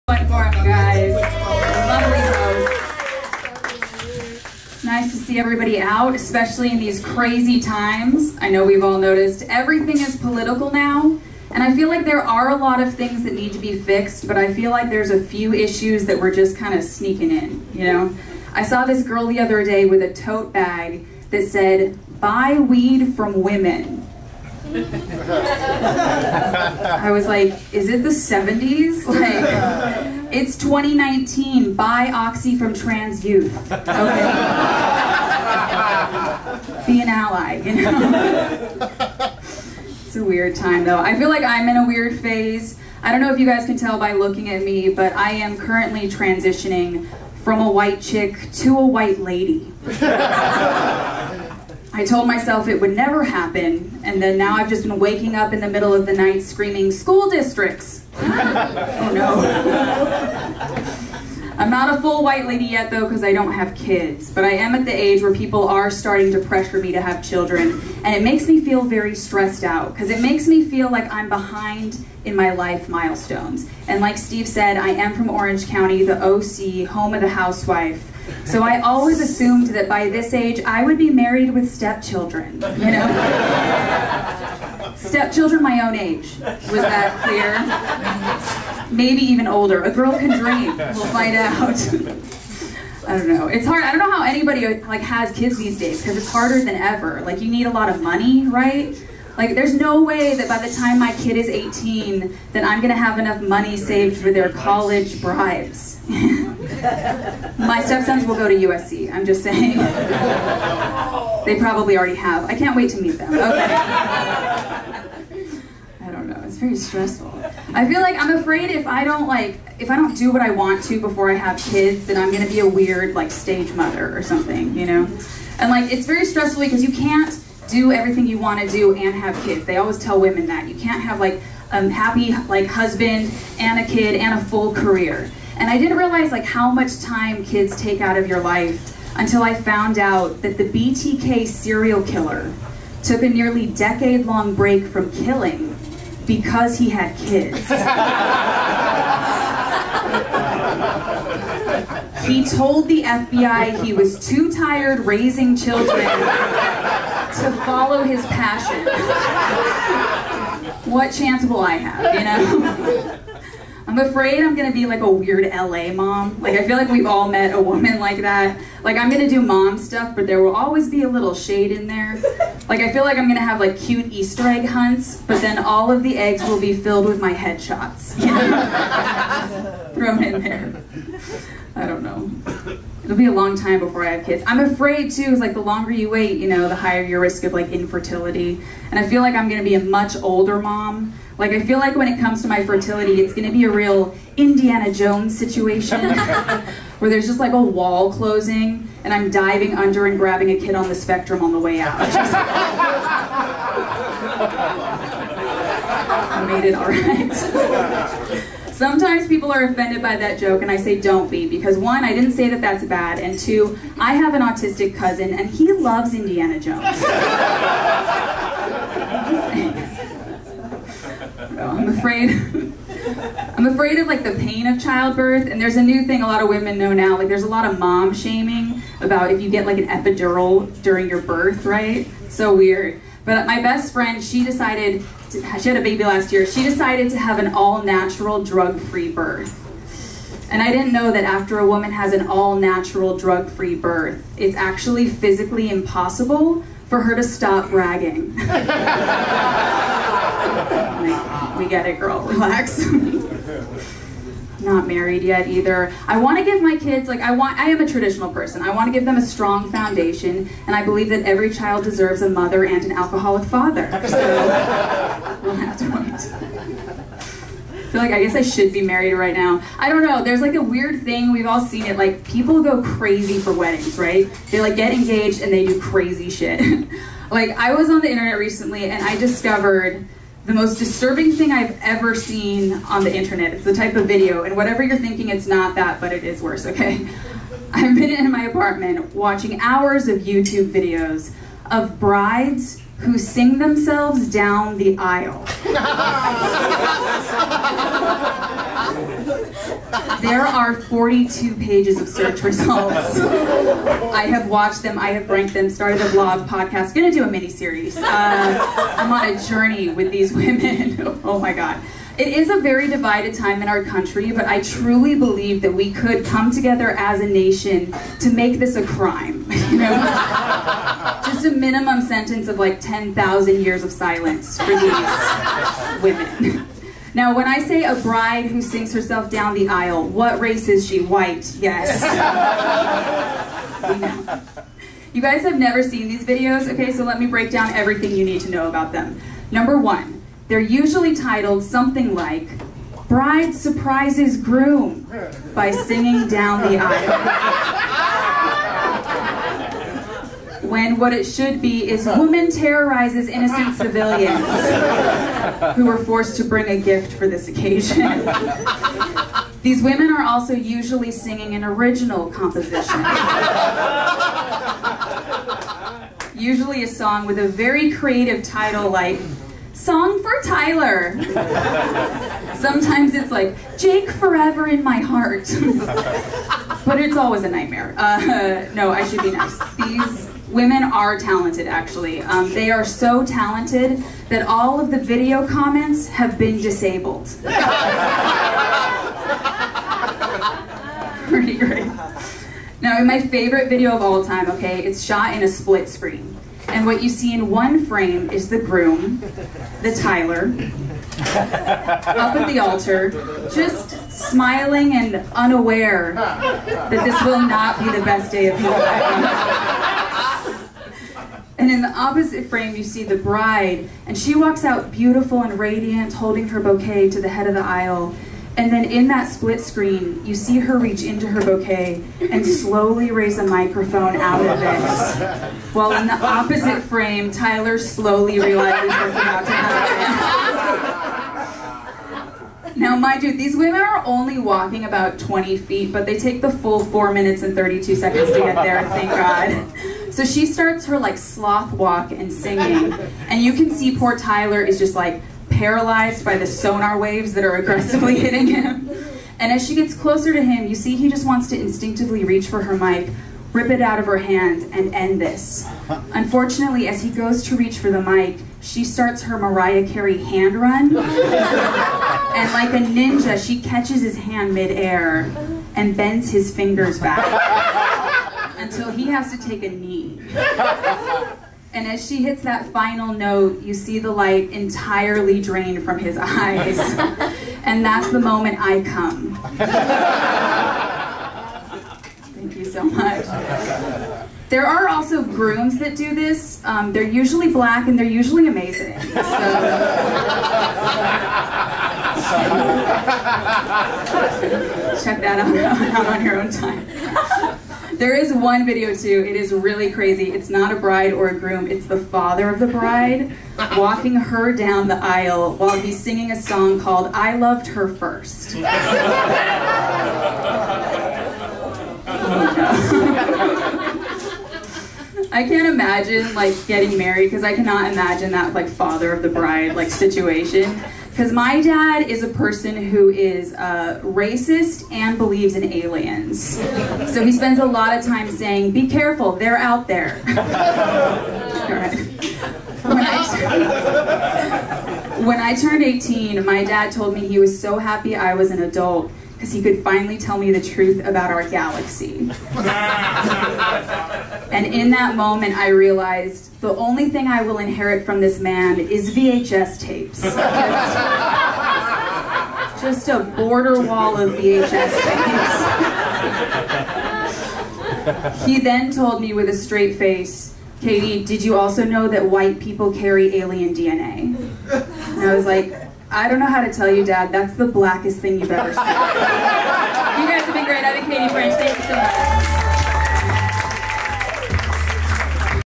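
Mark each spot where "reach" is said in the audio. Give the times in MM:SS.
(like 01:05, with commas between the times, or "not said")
07:00, 07:32, 07:37.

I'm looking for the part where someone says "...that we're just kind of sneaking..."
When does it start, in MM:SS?
00:16.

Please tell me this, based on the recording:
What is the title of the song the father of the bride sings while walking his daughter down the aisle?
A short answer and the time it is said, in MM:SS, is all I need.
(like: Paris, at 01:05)
I Loved Her First, at 08:27.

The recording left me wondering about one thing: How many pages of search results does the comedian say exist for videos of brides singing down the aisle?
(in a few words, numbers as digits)
42.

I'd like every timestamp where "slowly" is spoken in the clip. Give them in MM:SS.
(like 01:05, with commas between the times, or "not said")
07:02, 07:07.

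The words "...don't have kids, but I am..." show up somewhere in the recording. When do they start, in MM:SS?
01:03.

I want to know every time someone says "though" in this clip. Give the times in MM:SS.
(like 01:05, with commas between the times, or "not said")
00:40, 01:02, 03:41.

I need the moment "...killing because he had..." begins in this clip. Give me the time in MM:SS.
02:25.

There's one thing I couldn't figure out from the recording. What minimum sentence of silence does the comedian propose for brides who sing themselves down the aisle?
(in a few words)
10,000 years.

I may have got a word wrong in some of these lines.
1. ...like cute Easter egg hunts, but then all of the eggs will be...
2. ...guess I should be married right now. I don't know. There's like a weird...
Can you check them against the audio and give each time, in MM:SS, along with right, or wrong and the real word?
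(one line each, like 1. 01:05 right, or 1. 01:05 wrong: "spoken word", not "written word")
1. 02:53 right
2. 04:28 right.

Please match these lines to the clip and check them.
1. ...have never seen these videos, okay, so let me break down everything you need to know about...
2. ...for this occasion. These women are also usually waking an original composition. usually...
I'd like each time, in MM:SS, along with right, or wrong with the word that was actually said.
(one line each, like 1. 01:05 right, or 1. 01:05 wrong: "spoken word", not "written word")
1. 05:35 right
2. 05:57 wrong: "singing", not "waking".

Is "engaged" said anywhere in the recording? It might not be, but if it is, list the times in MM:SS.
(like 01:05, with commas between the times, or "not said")
04:34.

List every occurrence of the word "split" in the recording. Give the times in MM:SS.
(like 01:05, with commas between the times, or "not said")
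06:35, 06:59.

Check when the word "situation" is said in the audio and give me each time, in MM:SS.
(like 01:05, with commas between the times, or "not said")
03:15, 08:39.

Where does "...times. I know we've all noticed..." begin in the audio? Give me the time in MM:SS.
00:07.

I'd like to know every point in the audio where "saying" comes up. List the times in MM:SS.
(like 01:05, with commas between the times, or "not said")
01:49, 08:48.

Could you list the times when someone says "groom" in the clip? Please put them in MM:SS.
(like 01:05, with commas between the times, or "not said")
05:44, 06:38, 08:05, 08:21.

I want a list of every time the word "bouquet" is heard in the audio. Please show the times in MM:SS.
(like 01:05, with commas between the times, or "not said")
06:56, 07:01.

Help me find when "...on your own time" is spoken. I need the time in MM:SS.
08:16.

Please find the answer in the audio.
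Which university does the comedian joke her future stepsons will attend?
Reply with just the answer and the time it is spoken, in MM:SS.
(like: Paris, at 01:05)
USC, at 01:48.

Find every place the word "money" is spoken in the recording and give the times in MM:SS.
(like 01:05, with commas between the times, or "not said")
01:38, 01:43.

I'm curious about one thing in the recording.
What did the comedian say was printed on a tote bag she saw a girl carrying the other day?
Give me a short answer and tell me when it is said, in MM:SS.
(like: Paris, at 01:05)
buy weed from women, at 00:22.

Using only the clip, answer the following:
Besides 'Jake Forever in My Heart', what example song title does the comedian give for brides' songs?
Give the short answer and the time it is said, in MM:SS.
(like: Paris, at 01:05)
Song for Tyler, at 06:09.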